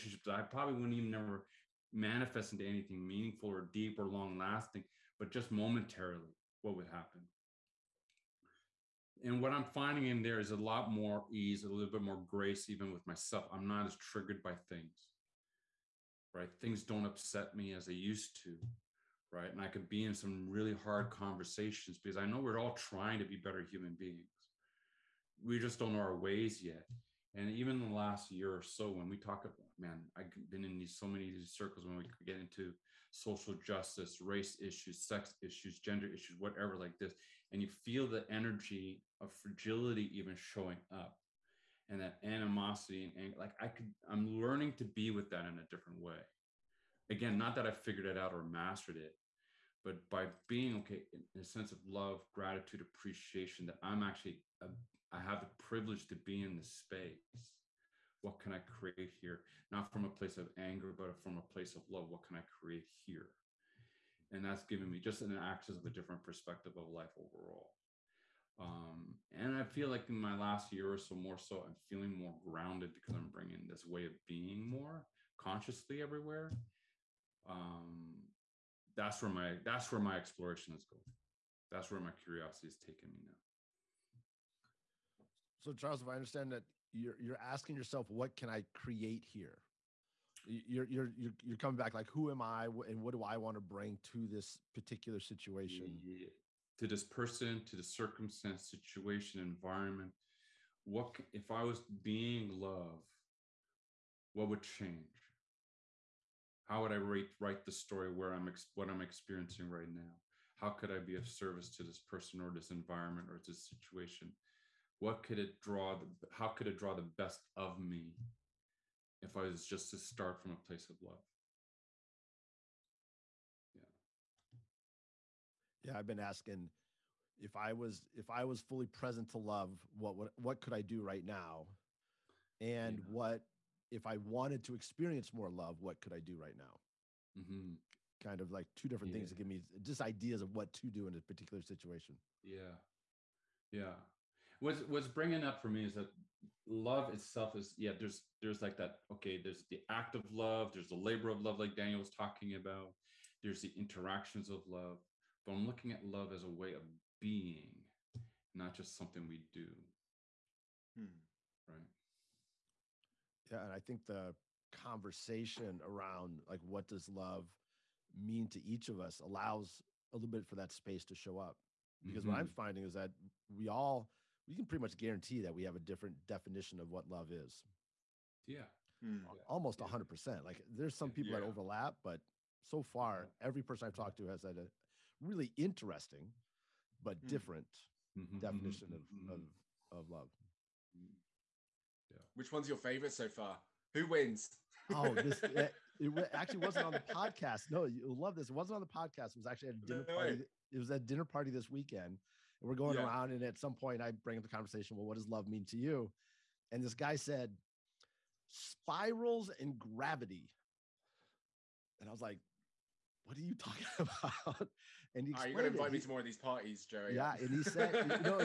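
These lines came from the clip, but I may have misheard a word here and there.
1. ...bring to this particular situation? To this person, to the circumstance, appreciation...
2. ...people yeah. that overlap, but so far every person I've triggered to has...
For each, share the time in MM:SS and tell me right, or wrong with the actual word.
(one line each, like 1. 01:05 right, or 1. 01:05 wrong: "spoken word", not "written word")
1. 01:33 wrong: "situation", not "appreciation"
2. 03:01 wrong: "talked", not "triggered".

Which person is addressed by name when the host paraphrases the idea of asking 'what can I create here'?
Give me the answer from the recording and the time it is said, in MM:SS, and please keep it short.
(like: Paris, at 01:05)
Charles, at 01:25.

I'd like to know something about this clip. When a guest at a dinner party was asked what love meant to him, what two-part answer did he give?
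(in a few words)
Spirals and gravity.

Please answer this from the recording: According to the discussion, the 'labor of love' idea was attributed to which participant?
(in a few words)
Daniel.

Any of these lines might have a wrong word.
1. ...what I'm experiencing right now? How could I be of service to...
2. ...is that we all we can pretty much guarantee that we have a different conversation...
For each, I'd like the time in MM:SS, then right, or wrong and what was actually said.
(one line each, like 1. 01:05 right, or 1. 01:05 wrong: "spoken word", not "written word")
1. 01:48 right
2. 02:52 wrong: "definition", not "conversation".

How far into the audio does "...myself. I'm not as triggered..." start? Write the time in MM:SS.
00:13.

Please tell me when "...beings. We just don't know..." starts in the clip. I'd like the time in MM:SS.
00:23.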